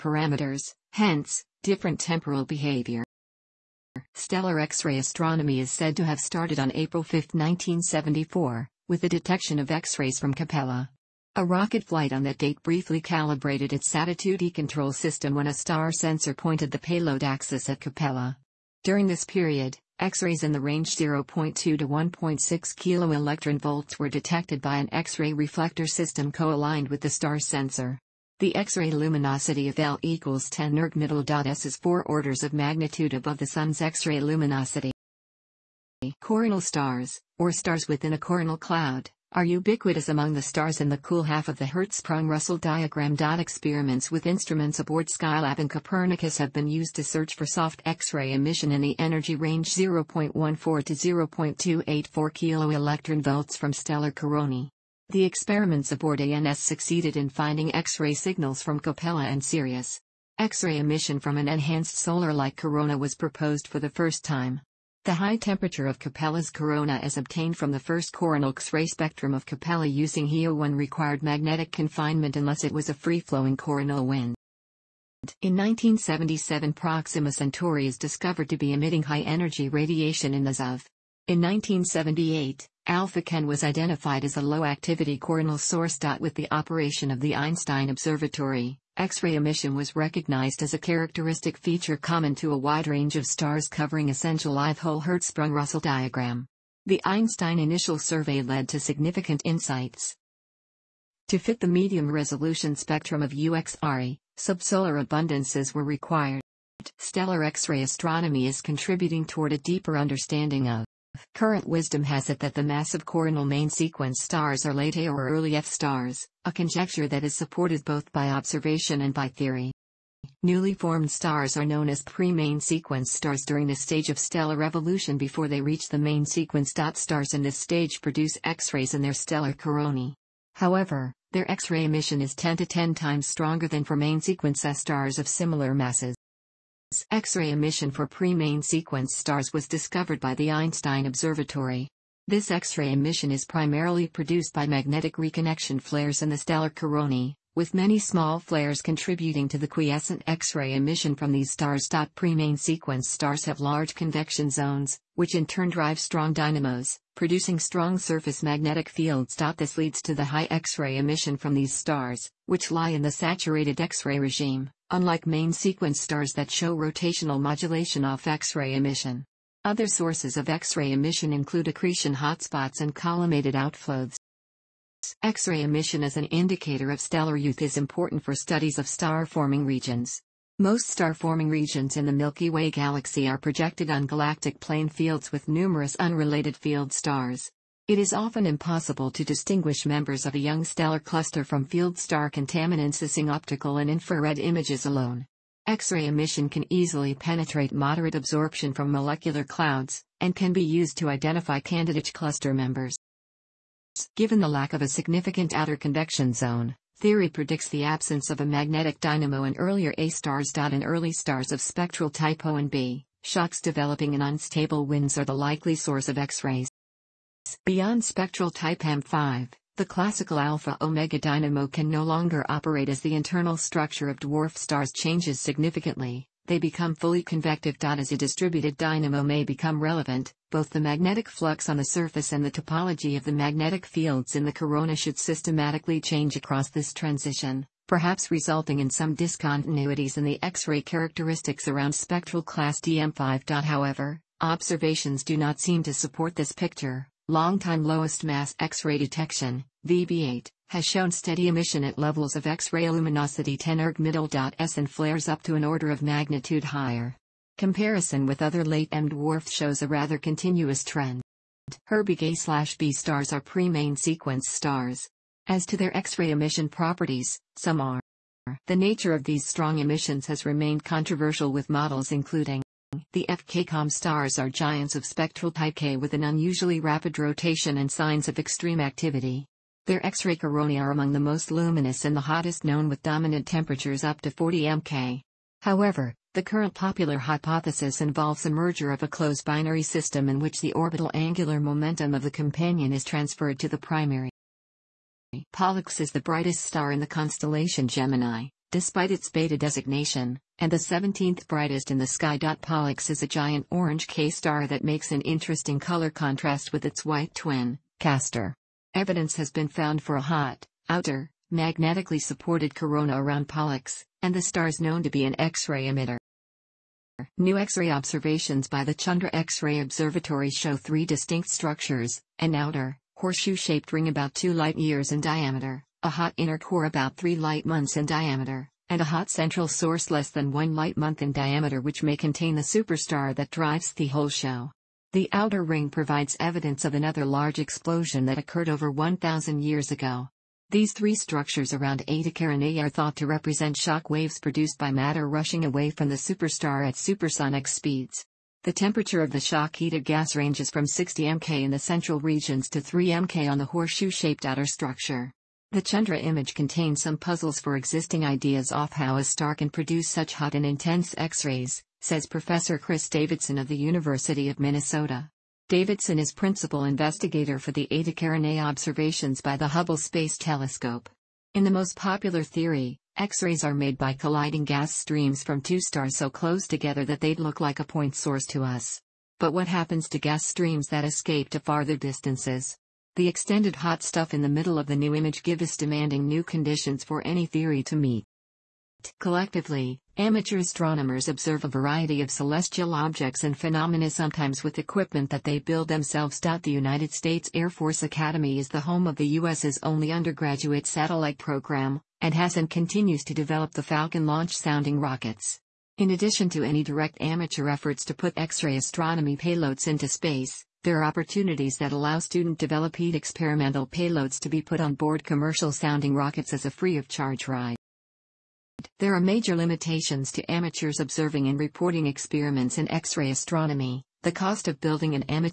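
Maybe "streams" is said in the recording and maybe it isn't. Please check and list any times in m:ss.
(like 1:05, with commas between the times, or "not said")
6:14, 6:20.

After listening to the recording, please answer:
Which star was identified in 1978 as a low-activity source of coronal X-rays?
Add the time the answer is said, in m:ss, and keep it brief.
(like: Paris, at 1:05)
Alpha Cen, at 1:22.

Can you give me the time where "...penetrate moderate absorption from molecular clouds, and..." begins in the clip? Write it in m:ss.
3:17.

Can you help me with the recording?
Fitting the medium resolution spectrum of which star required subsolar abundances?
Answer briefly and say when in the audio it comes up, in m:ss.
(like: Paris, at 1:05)
UX Ari, at 1:43.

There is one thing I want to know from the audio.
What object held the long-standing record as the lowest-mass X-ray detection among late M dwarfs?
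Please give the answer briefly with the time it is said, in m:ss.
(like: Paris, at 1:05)
VB8, at 4:09.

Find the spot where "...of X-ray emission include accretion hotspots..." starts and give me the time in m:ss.
2:50.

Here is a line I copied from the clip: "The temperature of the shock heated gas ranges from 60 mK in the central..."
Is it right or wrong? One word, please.
right.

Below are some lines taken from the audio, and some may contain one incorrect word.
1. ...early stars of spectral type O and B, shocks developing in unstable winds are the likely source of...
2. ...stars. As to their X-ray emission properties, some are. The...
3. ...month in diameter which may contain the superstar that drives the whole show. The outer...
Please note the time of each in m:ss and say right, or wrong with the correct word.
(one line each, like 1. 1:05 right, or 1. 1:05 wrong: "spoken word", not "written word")
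1. 3:30 right
2. 4:24 right
3. 5:30 right.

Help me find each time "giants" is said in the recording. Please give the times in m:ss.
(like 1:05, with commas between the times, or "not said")
4:34, 5:03.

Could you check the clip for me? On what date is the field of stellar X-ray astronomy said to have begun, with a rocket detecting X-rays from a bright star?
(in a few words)
April 5, 1974.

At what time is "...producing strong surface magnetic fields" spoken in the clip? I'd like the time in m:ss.
2:37.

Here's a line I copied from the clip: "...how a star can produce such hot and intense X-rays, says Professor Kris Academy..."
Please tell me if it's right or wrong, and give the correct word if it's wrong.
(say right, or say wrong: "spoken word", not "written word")
wrong: "Davidson", not "Academy".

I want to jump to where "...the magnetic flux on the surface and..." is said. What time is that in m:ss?
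3:50.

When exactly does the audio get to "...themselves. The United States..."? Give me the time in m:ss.
6:35.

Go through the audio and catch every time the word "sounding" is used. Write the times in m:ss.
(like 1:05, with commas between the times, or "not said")
6:44, 6:55.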